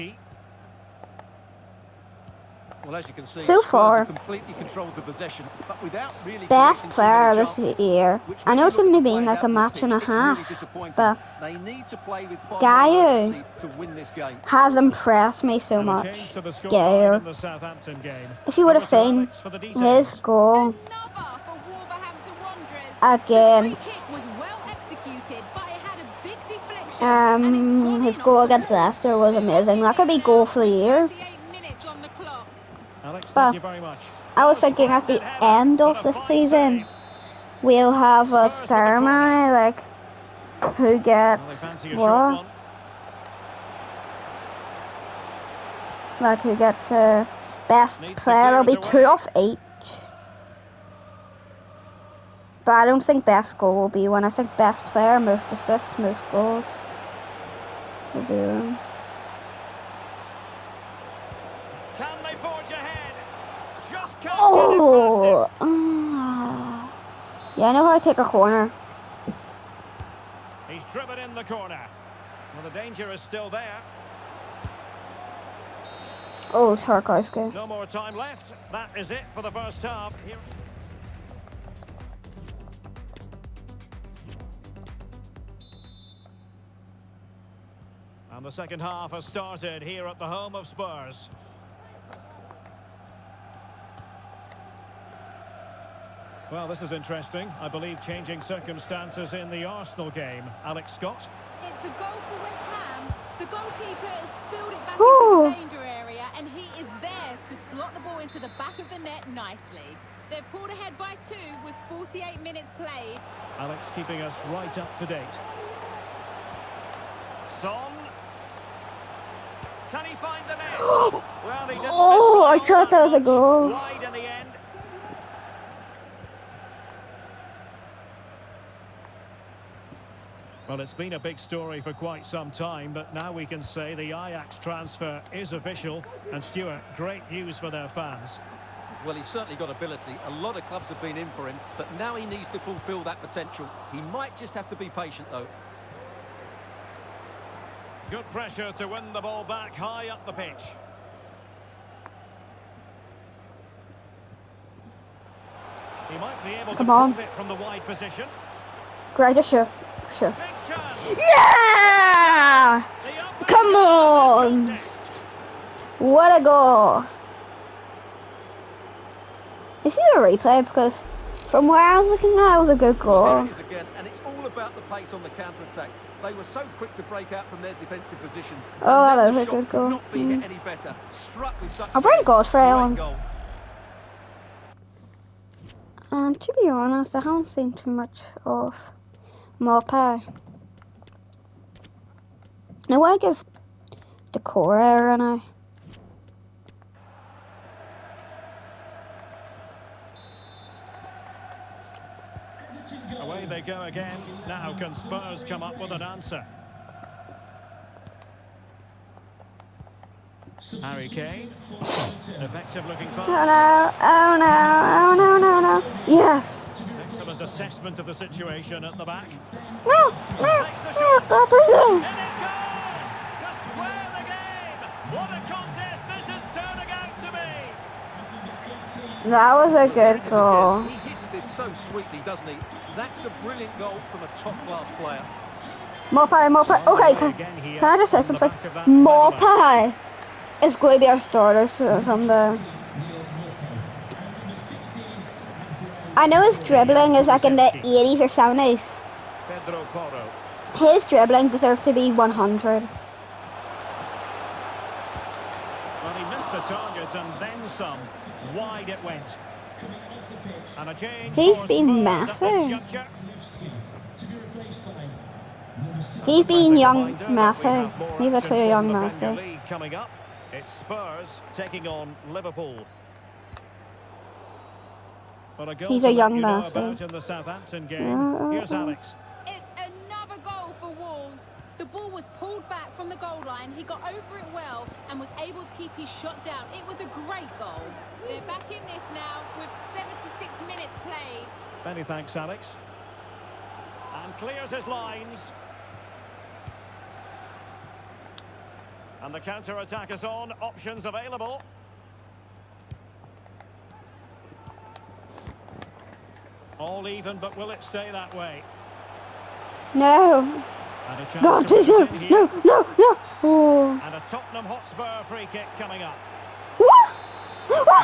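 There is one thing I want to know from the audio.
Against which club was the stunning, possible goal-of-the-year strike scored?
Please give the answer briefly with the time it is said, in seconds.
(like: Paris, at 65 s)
Leicester, at 28 s.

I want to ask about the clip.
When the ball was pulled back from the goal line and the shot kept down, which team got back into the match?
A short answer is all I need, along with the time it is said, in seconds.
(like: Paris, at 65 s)
Wolves, at 280 s.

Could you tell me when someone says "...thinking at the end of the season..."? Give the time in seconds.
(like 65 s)
34 s.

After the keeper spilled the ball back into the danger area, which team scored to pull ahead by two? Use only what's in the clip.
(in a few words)
West Ham.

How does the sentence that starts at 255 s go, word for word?
Well, he missed the target and then some.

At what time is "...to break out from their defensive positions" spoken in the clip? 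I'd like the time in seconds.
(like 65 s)
176 s.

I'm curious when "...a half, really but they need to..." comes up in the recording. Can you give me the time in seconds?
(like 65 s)
9 s.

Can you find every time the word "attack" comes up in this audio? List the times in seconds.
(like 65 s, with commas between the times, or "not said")
175 s, 299 s.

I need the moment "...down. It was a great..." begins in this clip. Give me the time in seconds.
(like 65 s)
286 s.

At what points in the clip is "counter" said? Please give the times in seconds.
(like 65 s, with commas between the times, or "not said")
175 s, 299 s.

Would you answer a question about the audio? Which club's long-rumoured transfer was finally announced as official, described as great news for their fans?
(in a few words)
Ajax.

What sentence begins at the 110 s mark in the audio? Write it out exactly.
They're pulled ahead by two with 48 minutes played.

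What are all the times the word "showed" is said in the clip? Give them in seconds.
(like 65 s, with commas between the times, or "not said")
not said.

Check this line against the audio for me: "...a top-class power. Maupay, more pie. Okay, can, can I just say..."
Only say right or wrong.
wrong.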